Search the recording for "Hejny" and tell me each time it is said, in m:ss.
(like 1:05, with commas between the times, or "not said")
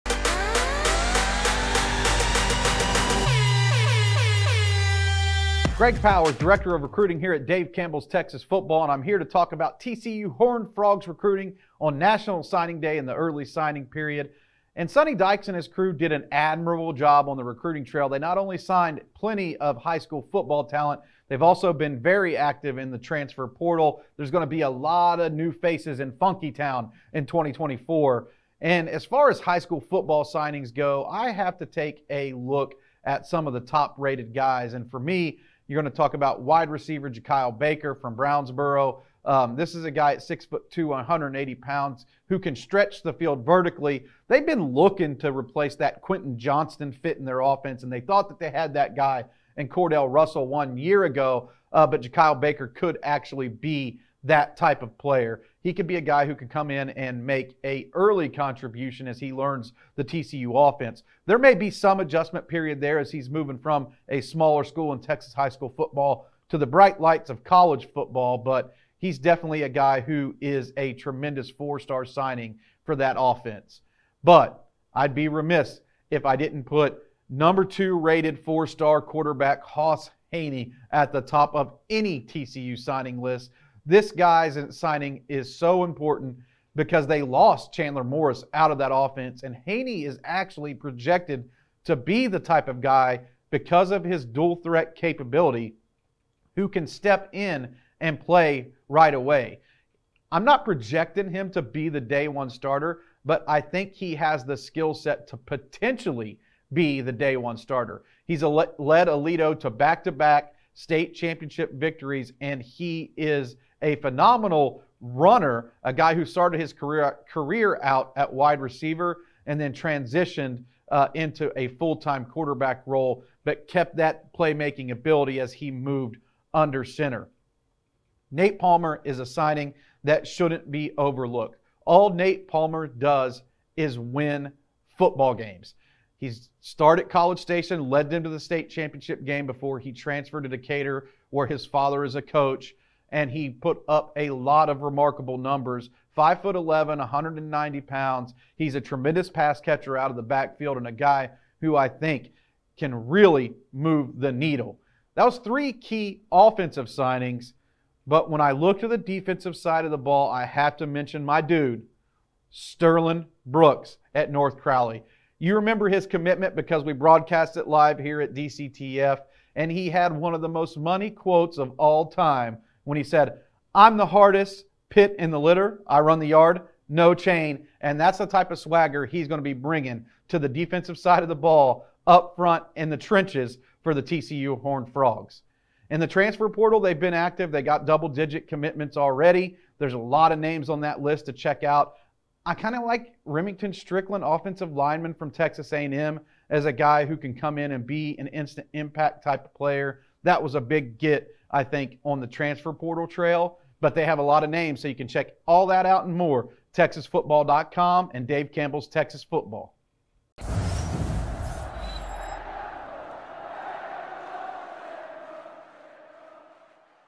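1:20, 1:29.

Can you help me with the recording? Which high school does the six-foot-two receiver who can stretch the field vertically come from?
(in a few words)
Brownsboro.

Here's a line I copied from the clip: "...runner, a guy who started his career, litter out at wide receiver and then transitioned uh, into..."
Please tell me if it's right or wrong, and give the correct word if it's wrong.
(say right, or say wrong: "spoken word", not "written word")
wrong: "career", not "litter".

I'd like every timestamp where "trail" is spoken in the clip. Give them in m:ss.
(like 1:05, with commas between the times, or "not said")
0:17, 3:23.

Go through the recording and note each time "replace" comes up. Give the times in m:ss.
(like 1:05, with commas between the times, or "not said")
0:45.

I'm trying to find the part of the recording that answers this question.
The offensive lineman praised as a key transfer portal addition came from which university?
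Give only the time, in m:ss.
3:15.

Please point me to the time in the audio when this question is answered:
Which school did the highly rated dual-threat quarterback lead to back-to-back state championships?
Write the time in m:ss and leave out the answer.
1:48.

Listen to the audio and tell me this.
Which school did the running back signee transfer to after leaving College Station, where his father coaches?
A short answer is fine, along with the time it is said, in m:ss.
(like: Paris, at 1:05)
Decatur, at 2:20.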